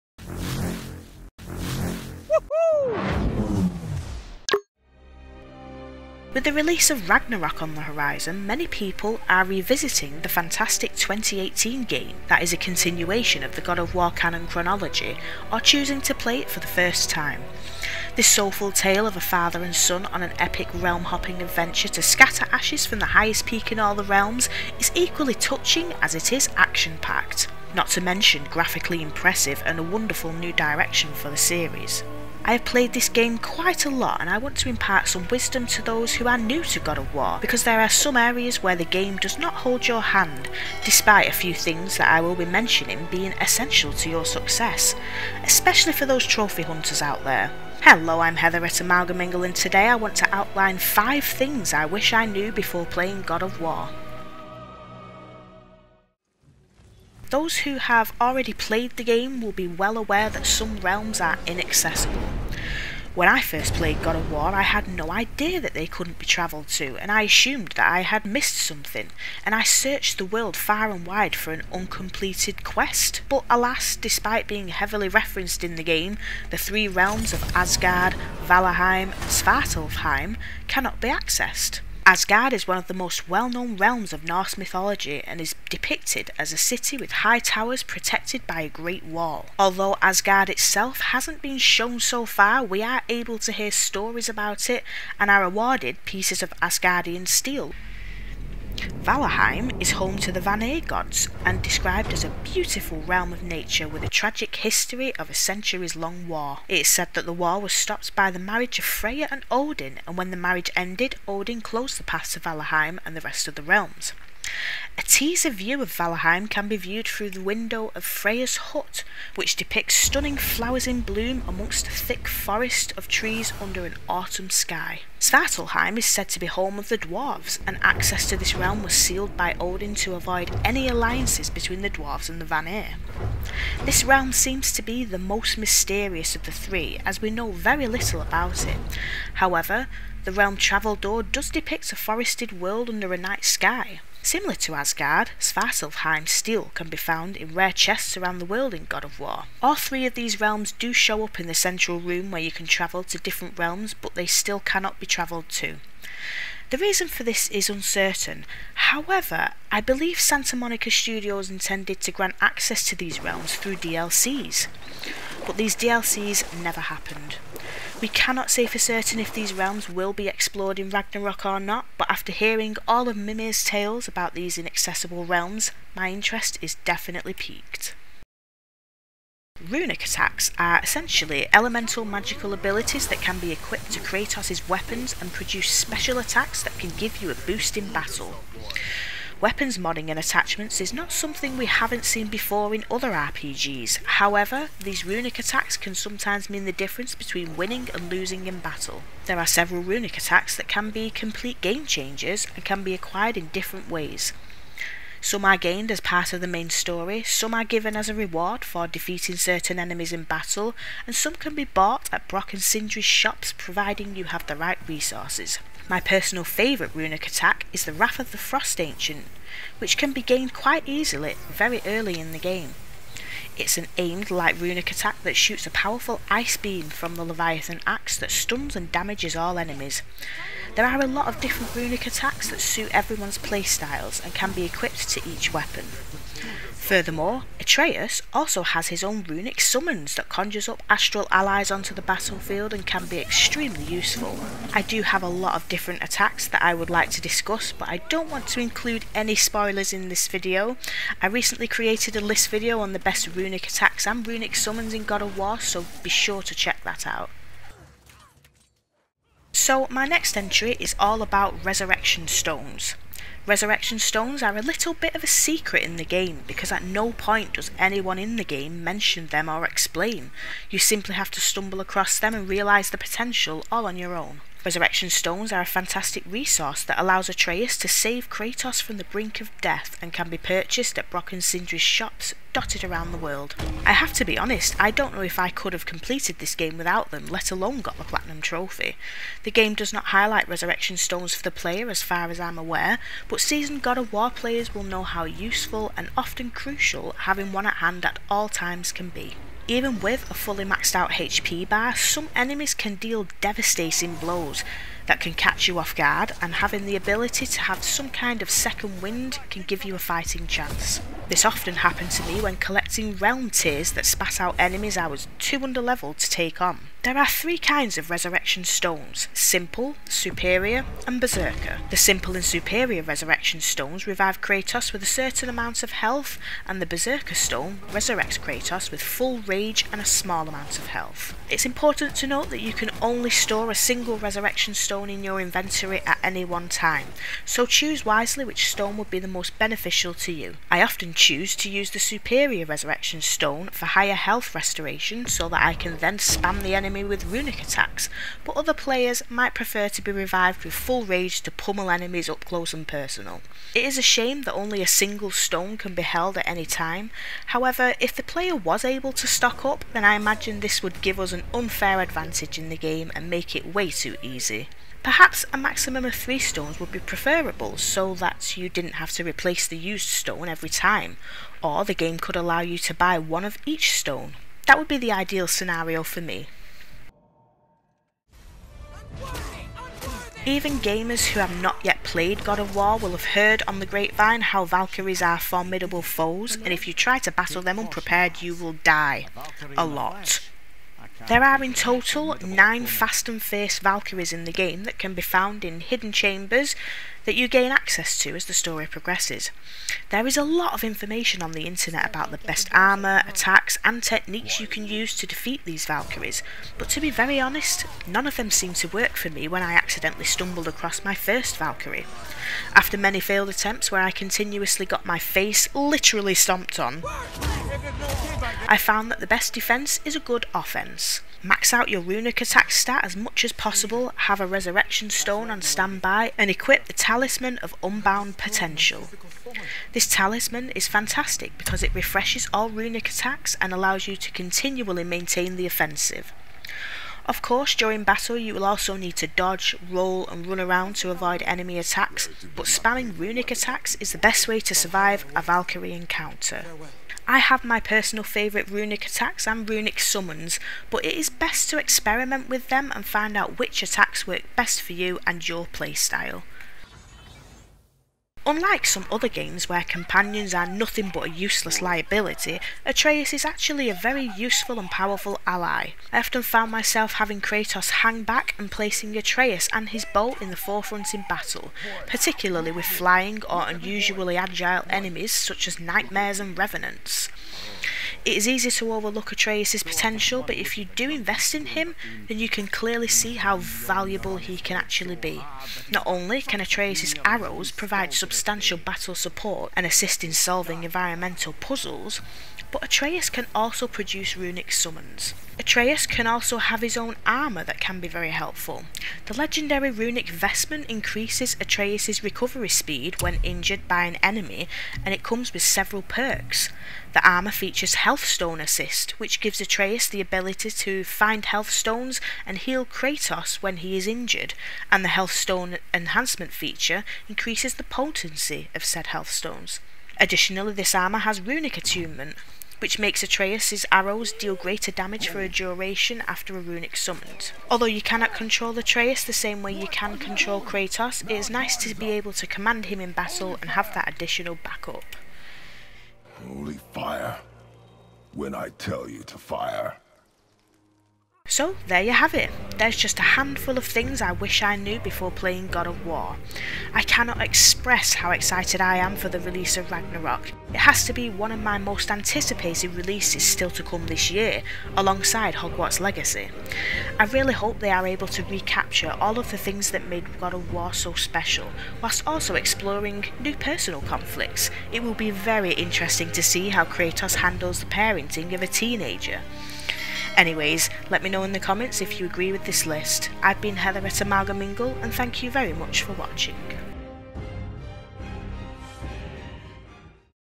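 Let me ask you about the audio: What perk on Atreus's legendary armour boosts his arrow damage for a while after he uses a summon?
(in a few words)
runic attunement.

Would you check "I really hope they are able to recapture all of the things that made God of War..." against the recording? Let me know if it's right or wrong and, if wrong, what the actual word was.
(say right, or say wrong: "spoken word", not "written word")
right.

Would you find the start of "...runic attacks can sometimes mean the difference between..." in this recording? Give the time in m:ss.
3:15.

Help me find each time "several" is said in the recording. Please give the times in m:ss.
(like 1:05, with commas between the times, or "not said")
3:19, 8:25.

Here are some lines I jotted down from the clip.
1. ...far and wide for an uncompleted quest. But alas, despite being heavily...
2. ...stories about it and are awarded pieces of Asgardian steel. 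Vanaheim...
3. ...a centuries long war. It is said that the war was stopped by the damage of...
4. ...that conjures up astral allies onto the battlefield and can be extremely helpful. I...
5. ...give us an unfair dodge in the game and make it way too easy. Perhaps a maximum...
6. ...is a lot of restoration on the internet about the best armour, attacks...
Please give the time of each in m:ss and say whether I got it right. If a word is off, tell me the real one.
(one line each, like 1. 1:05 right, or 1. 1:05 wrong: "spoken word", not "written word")
1. 1:10 right
2. 1:33 right
3. 1:45 wrong: "marriage", not "damage"
4. 4:00 wrong: "useful", not "helpful"
5. 6:01 wrong: "advantage", not "dodge"
6. 6:40 wrong: "information", not "restoration".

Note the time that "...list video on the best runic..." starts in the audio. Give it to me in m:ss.
4:12.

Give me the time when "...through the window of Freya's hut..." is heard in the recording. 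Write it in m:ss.
1:57.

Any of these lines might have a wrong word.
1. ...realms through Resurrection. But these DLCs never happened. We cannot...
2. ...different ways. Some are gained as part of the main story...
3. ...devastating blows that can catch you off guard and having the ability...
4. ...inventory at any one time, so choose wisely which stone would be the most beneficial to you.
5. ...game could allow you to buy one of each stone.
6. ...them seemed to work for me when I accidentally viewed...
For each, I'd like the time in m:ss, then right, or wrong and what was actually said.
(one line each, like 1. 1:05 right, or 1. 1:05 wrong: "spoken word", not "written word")
1. 2:43 wrong: "DLCs", not "Resurrection"
2. 3:23 right
3. 5:03 right
4. 5:35 right
5. 6:11 right
6. 6:48 wrong: "stumbled", not "viewed".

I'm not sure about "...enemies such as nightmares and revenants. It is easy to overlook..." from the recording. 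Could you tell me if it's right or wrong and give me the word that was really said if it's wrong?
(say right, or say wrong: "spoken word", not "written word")
right.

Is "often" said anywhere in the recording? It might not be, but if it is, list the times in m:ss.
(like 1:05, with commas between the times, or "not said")
4:56, 5:11, 5:40, 7:46.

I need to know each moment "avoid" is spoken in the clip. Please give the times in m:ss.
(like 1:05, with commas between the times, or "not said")
2:10, 7:21.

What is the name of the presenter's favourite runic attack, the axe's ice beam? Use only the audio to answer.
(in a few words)
Wrath of the Frost Ancient.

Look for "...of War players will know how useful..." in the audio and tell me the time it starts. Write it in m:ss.
4:53.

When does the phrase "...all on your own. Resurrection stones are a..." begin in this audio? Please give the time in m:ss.
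4:33.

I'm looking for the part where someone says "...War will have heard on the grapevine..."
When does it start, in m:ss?
6:22.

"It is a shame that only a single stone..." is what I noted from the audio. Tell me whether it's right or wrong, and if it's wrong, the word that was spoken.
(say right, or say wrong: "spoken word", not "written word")
right.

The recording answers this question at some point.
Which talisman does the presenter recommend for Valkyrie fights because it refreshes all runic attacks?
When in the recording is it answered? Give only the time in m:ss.
7:06.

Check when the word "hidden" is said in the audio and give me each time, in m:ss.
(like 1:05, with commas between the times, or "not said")
6:35.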